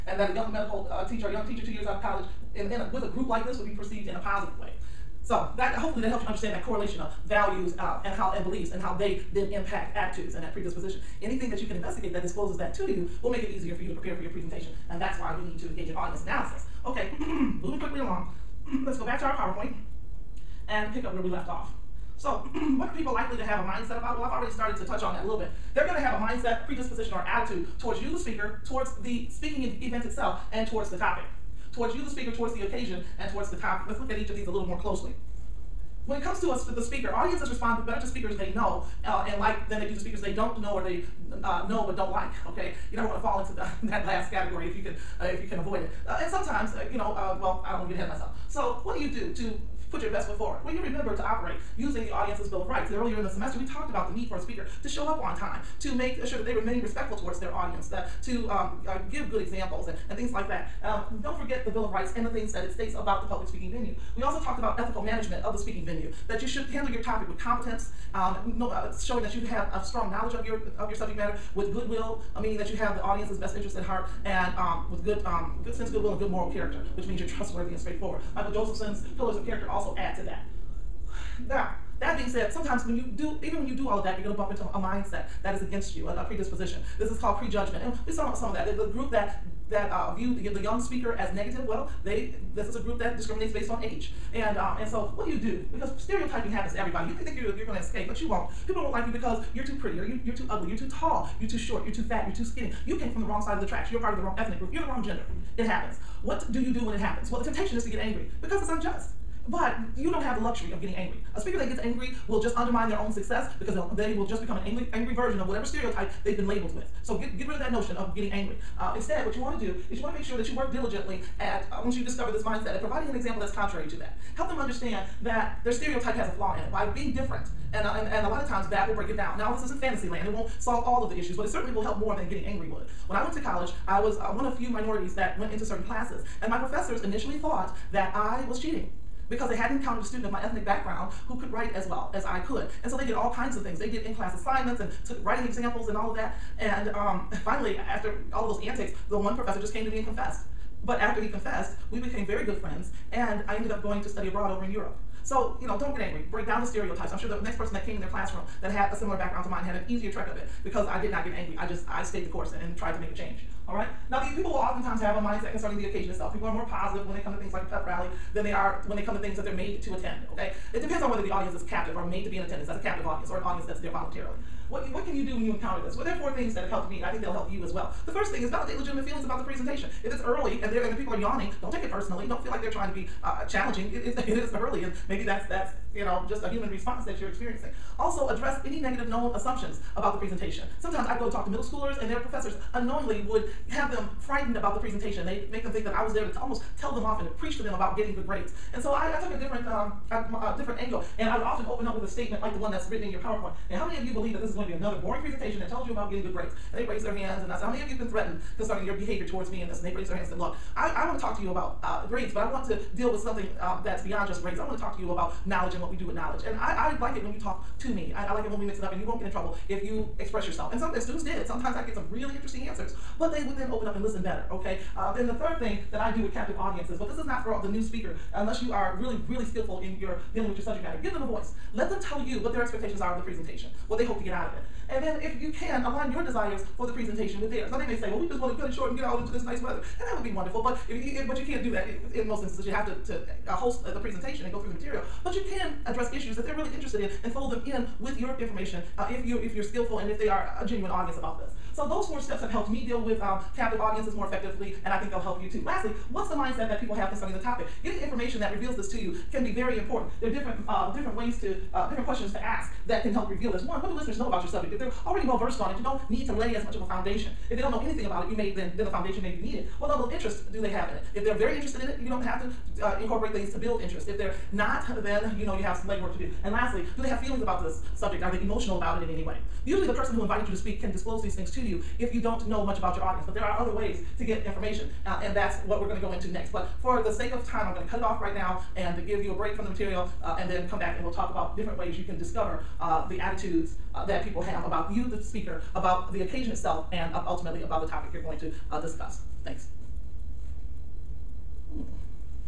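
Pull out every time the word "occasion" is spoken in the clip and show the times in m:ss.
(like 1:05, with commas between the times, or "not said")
0:32, 2:45, 4:56.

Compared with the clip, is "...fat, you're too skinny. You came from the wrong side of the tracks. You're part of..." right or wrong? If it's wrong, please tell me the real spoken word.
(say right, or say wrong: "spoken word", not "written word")
right.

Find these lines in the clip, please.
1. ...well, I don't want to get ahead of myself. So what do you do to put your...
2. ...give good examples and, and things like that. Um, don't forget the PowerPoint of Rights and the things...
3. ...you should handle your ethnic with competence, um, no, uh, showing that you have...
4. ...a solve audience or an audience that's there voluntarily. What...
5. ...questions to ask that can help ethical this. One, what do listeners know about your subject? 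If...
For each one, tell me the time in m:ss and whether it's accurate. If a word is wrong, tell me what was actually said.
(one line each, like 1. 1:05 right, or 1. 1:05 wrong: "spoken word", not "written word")
1. 0:47 right
2. 0:59 wrong: "Bill", not "PowerPoint"
3. 1:06 wrong: "topic", not "ethnic"
4. 2:52 wrong: "captive", not "solve"
5. 4:22 wrong: "reveal", not "ethical".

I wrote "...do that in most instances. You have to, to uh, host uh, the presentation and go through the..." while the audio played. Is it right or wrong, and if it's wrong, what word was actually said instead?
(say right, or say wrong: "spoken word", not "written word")
right.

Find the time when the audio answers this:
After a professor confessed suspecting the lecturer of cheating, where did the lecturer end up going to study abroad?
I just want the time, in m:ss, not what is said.
2:34.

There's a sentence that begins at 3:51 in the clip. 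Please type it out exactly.
Let them tell you what their expectations are of the presentation, what they hope to get out of it.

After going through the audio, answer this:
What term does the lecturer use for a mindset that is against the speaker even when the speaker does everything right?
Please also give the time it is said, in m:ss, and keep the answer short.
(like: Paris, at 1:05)
prejudgment, at 1:27.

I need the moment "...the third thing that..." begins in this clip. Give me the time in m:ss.
3:45.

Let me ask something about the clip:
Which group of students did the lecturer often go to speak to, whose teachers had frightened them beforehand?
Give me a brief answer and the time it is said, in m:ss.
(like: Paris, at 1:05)
middle schoolers, at 3:11.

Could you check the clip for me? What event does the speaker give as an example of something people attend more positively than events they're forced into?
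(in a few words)
a pep rally.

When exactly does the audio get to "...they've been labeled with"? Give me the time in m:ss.
1:56.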